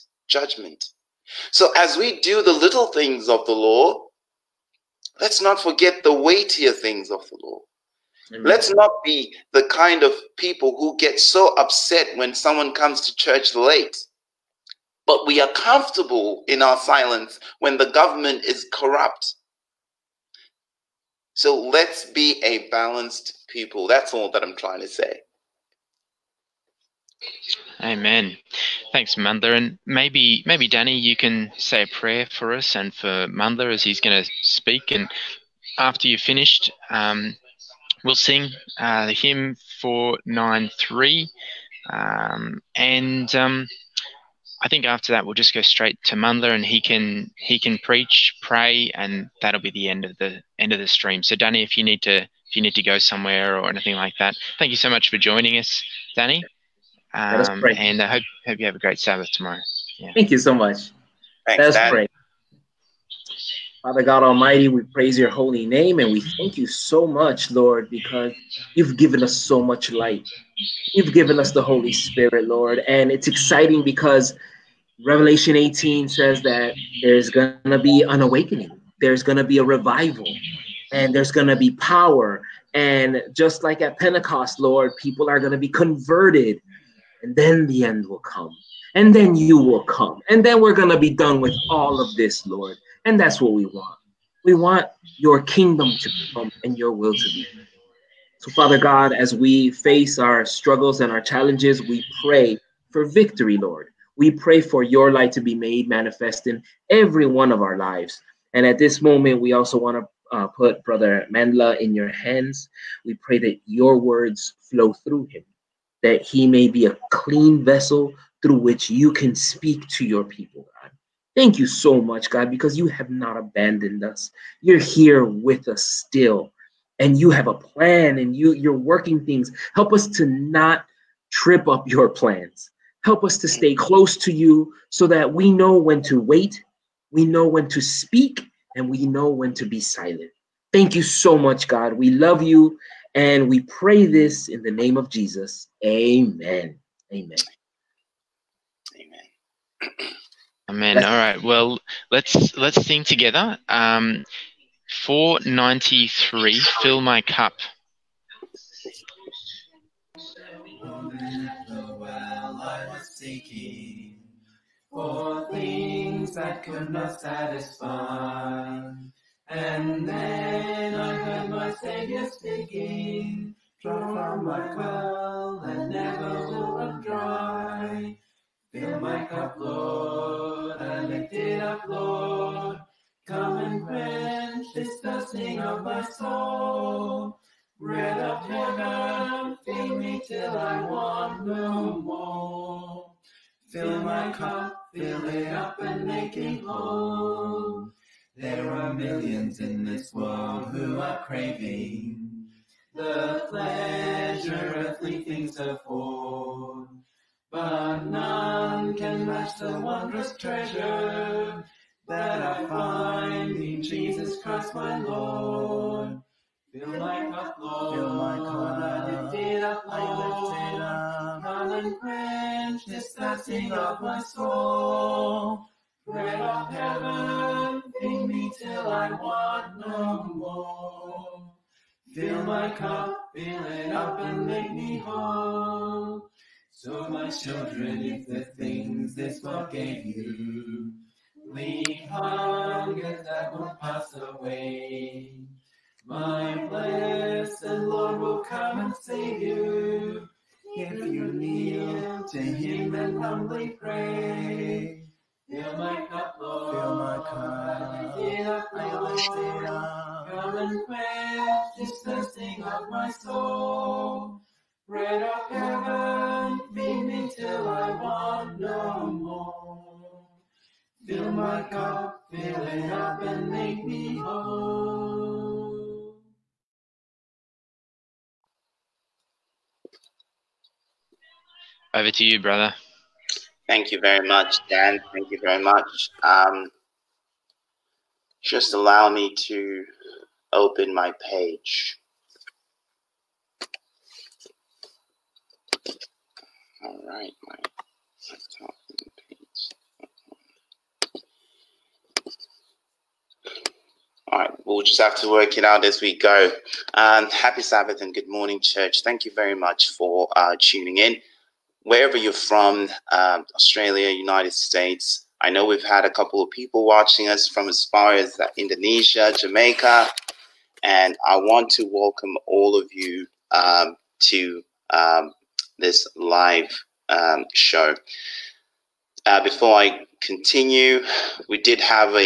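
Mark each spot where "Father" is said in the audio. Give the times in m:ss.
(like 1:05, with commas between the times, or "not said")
1:03, 1:38.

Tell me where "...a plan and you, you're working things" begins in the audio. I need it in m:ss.
2:07.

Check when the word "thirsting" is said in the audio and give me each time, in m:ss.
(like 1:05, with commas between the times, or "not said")
3:04, 3:43, 4:22.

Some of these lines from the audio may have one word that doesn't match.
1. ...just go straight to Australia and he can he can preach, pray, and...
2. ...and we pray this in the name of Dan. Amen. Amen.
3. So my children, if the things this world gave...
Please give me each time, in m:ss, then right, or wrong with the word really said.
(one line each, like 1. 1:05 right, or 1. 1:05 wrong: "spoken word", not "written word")
1. 0:45 wrong: "Mandla", not "Australia"
2. 2:23 wrong: "Jesus", not "Dan"
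3. 3:56 right.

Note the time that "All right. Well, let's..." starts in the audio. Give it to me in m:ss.
2:30.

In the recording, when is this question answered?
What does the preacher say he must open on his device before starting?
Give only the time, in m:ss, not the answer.
4:58.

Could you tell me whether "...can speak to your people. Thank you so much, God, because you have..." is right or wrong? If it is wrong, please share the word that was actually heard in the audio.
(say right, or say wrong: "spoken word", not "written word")
right.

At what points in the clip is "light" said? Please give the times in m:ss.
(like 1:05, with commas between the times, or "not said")
1:09, 1:45.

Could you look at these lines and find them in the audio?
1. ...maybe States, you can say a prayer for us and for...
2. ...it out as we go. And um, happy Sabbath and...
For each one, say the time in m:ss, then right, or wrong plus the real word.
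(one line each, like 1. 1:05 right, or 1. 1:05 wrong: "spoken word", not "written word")
1. 0:30 wrong: "Danny", not "States"
2. 5:05 right.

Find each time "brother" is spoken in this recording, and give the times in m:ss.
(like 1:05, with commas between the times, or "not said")
1:50, 4:42.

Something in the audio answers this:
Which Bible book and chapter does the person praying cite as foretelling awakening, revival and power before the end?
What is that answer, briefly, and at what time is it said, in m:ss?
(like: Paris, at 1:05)
Revelation 18, at 1:15.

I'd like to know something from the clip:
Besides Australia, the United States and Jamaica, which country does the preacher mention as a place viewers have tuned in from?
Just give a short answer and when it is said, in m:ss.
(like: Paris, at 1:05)
Indonesia, at 5:18.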